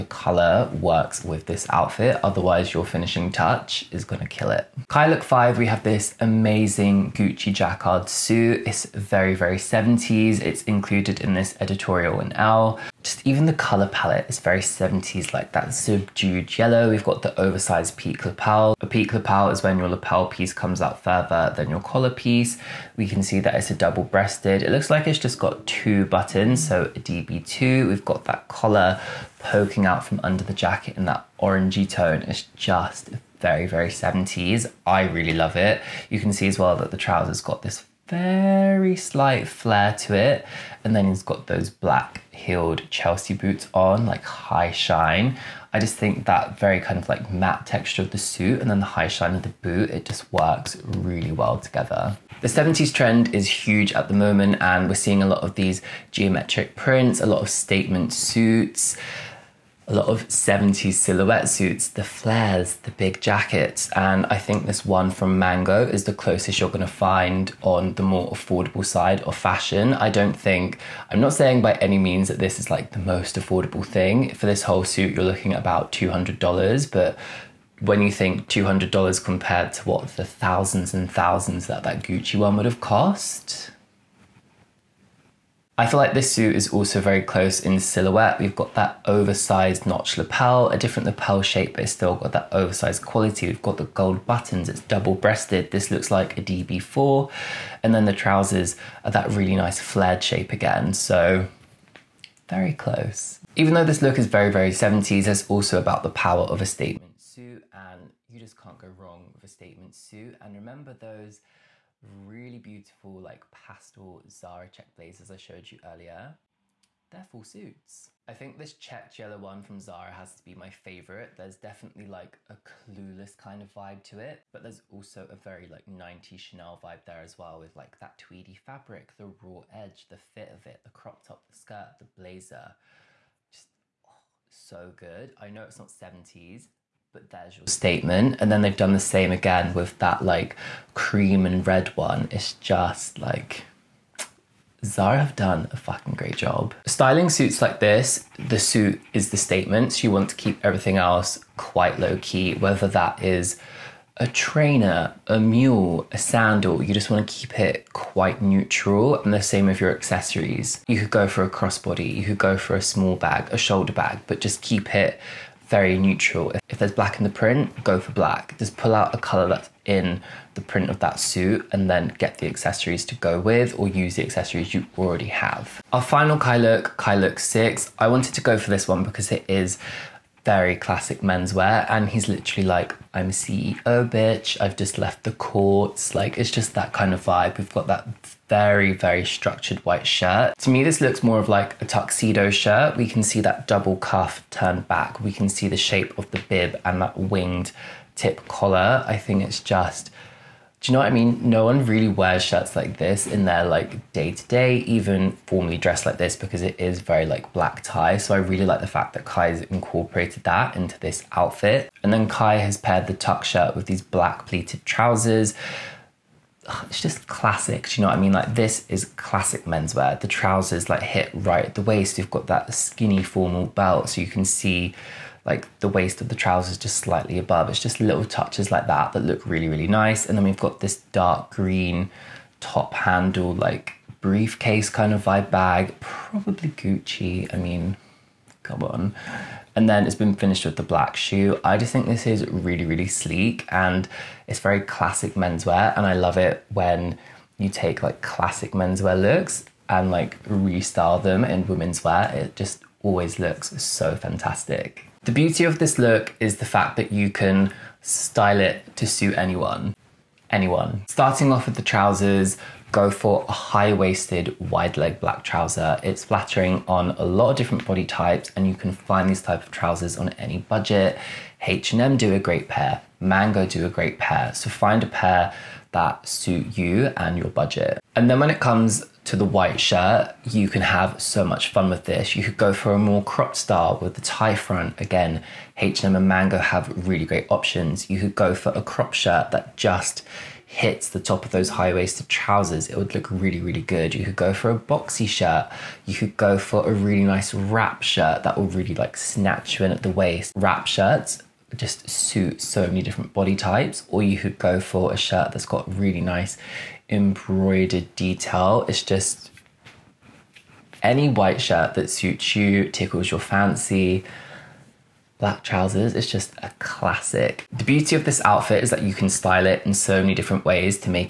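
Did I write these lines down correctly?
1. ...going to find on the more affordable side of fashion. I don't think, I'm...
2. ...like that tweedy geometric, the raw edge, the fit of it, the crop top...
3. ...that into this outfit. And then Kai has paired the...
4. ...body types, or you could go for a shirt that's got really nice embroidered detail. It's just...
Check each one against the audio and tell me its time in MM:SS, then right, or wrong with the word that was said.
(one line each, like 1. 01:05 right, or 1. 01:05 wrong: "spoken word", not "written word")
1. 01:06 right
2. 02:07 wrong: "fabric", not "geometric"
3. 03:30 right
4. 05:03 right.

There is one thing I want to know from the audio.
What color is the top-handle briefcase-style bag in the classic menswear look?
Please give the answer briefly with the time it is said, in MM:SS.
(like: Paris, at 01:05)
Dark green, at 03:51.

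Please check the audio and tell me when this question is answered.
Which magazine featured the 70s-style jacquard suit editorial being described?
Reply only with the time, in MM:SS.
00:12.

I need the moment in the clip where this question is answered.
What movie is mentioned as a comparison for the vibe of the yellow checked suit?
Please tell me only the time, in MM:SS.
02:02.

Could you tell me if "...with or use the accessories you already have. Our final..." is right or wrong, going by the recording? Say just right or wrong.
right.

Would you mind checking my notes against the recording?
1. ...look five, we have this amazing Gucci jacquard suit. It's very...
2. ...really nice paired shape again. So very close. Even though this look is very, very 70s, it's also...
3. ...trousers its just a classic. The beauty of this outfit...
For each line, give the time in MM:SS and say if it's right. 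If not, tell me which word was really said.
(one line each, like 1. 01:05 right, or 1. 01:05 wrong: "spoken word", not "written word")
1. 00:05 right
2. 01:39 wrong: "flared", not "paired"
3. 05:15 right.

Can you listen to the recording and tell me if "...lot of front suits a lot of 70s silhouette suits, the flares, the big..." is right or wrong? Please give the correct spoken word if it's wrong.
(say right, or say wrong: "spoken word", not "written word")
wrong: "statement", not "front".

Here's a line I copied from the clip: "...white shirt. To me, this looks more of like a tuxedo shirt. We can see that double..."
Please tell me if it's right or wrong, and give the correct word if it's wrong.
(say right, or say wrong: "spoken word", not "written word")
right.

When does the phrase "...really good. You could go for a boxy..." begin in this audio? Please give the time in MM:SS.
04:53.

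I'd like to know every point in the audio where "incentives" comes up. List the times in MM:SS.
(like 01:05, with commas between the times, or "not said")
not said.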